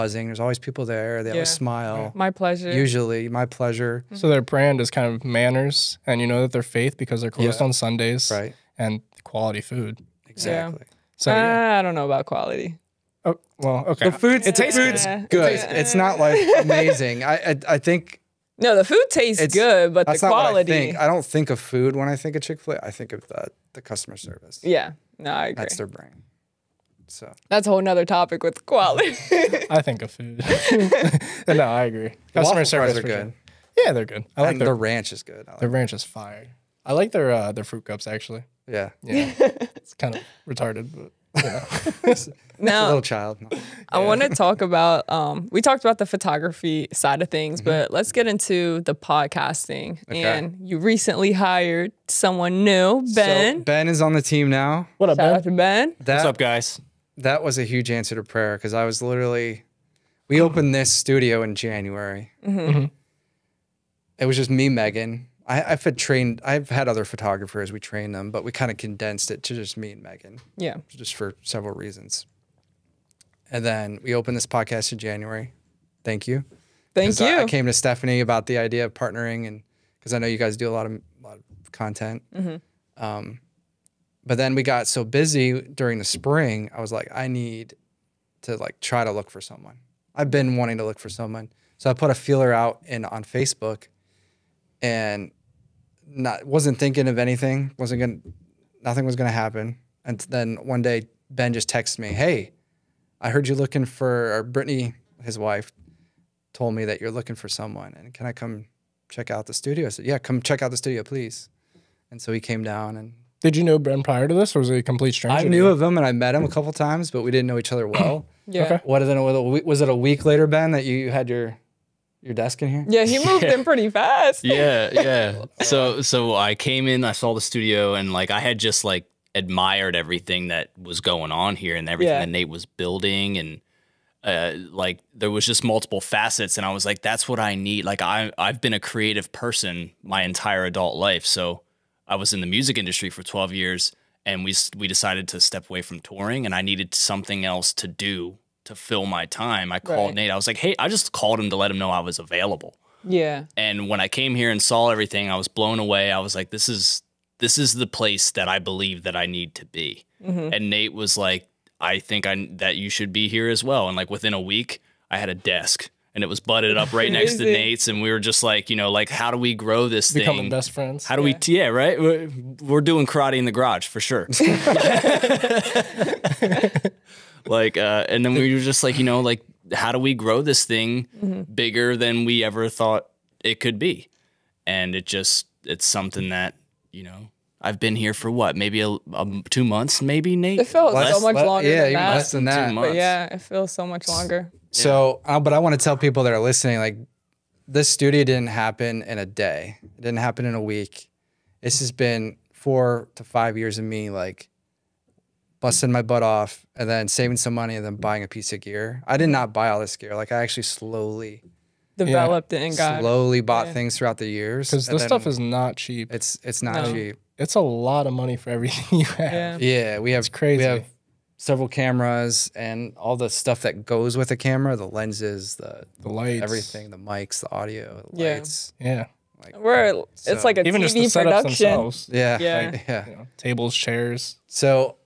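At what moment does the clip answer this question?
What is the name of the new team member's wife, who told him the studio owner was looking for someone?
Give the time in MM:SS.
01:44.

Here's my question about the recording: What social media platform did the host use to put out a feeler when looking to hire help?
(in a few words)
Facebook.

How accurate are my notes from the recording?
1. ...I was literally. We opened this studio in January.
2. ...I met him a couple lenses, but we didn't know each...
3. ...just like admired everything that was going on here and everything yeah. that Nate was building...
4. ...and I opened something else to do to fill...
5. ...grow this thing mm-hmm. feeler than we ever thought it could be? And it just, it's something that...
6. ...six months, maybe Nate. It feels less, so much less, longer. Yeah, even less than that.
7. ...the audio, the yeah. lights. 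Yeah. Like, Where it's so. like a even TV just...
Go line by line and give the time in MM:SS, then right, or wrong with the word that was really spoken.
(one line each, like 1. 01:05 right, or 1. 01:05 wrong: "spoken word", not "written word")
1. 00:58 right
2. 01:56 wrong: "times", not "lenses"
3. 02:08 right
4. 02:26 wrong: "needed", not "opened"
5. 03:00 wrong: "bigger", not "feeler"
6. 03:09 wrong: "two", not "six"
7. 03:47 right.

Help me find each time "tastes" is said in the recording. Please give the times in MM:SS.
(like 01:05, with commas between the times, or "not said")
00:14, 00:19.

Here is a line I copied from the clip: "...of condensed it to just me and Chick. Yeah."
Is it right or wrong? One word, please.
wrong.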